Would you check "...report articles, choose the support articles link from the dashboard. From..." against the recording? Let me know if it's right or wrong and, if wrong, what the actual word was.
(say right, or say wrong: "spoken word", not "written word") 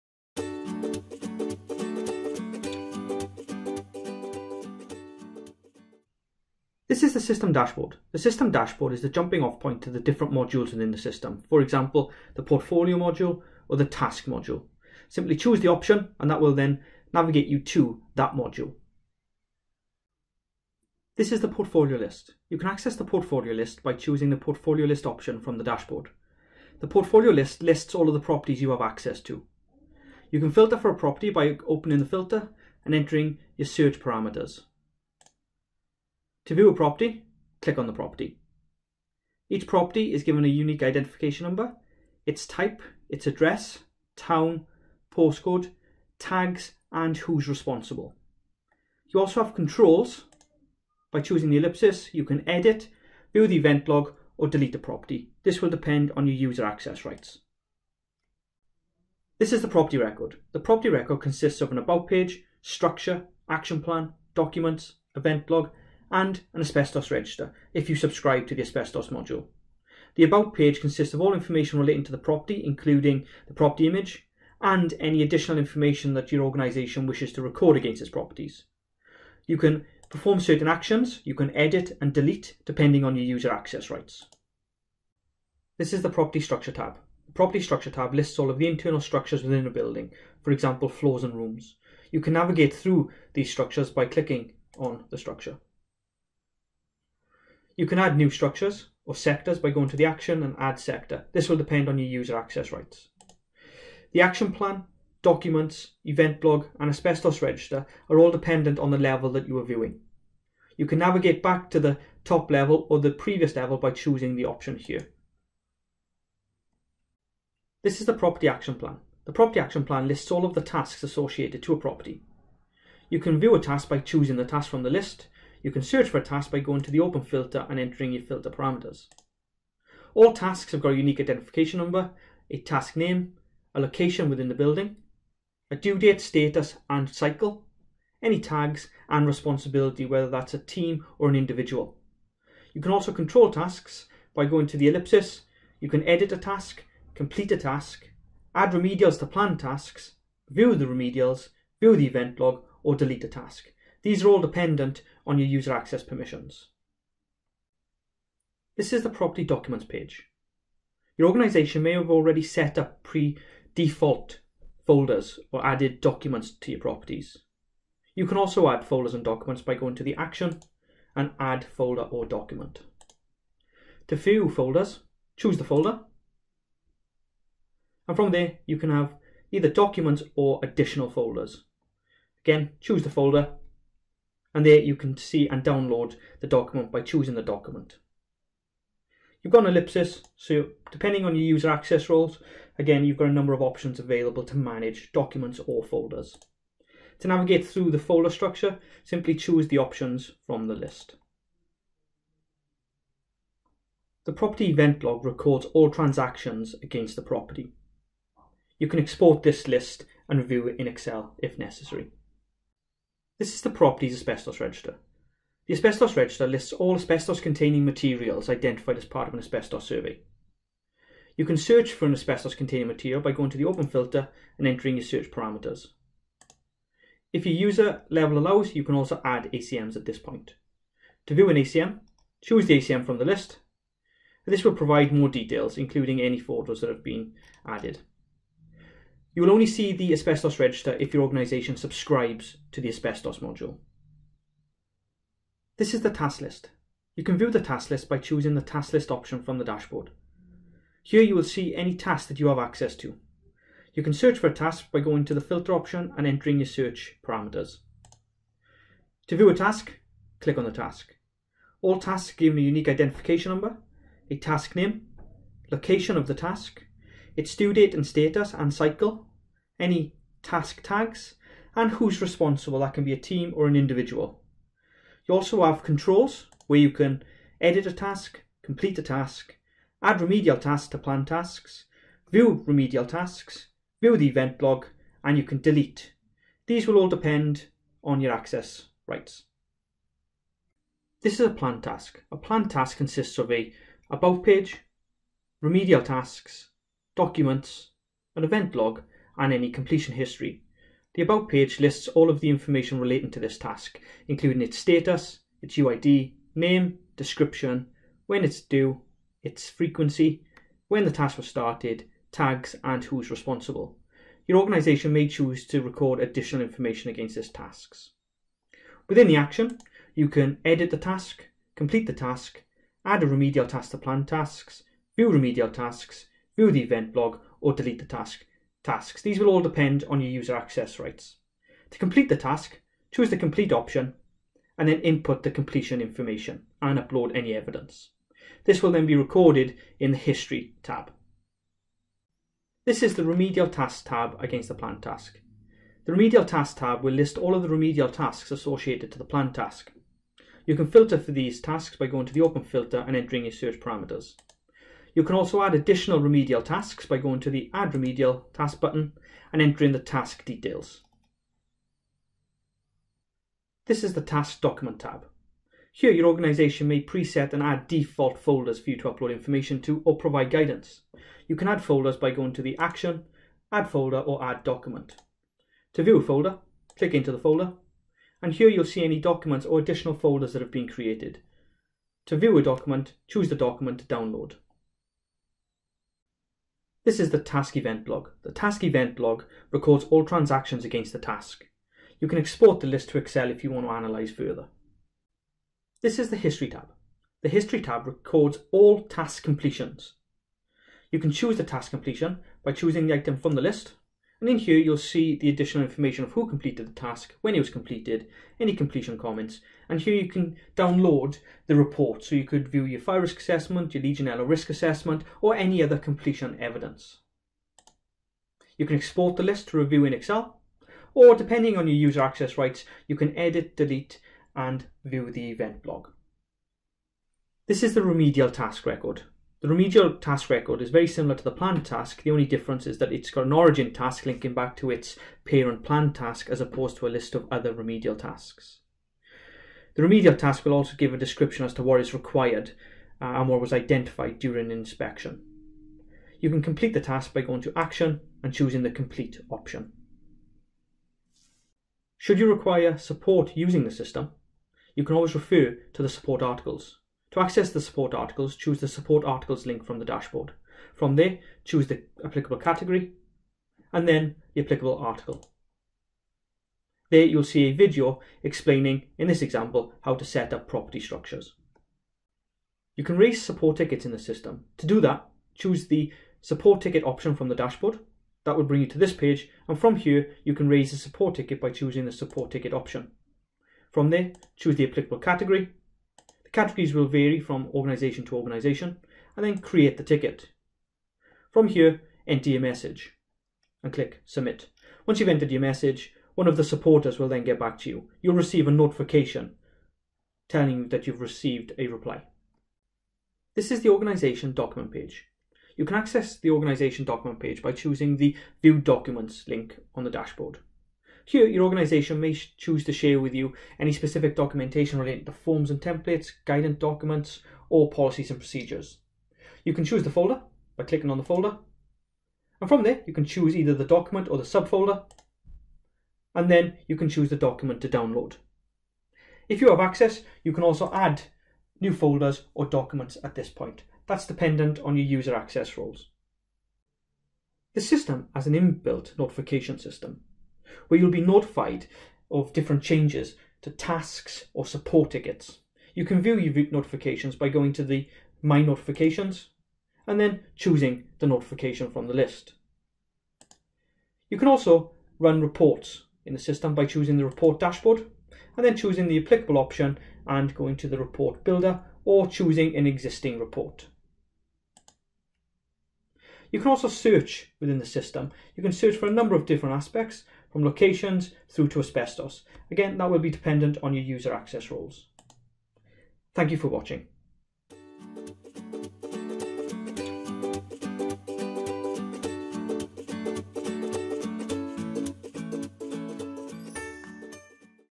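wrong: "support", not "report".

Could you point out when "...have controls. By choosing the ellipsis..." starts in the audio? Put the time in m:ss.
0:49.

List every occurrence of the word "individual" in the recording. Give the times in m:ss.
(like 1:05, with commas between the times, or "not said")
2:21, 4:33.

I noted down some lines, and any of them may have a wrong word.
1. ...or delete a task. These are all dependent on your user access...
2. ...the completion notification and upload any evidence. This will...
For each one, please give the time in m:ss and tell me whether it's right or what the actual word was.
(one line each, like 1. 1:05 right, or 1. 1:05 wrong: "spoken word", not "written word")
1. 2:32 right
2. 5:35 wrong: "information", not "notification".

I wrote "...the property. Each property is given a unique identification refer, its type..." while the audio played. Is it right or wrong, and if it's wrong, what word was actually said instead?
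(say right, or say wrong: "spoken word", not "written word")
wrong: "number", not "refer".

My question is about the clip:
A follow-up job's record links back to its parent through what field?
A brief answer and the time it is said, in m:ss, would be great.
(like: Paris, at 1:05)
Origin task, at 7:13.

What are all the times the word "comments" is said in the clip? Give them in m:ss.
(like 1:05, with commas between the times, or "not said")
6:49.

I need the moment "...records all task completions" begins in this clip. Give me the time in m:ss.
6:38.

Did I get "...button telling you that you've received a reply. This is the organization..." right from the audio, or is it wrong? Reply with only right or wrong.
wrong.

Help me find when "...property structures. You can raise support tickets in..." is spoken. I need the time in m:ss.
7:50.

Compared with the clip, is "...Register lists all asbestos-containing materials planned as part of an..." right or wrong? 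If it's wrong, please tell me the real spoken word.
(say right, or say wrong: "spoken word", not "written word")
wrong: "identified", not "planned".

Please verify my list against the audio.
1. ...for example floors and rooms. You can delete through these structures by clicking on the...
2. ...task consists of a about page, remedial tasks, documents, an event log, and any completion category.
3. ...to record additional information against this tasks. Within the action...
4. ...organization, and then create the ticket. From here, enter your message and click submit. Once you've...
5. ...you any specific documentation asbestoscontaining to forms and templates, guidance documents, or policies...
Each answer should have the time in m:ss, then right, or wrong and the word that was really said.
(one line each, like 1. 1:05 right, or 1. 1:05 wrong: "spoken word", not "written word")
1. 1:30 wrong: "navigate", not "delete"
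2. 4:52 wrong: "history", not "category"
3. 5:15 right
4. 8:08 right
5. 8:33 wrong: "relating", not "asbestoscontaining".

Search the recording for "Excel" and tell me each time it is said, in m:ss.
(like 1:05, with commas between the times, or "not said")
3:30, 6:33, 7:00.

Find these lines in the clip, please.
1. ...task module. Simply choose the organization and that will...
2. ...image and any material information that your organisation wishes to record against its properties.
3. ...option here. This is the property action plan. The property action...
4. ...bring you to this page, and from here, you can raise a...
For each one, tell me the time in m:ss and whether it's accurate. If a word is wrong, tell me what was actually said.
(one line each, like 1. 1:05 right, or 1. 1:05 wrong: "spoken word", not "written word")
1. 0:13 wrong: "option", not "organization"
2. 1:13 wrong: "additional", not "material"
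3. 1:54 right
4. 7:58 right.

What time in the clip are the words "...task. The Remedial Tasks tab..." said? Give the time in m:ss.
5:45.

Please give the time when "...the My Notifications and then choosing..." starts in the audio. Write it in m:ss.
9:07.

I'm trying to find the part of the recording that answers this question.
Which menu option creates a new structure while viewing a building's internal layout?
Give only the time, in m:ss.
1:40.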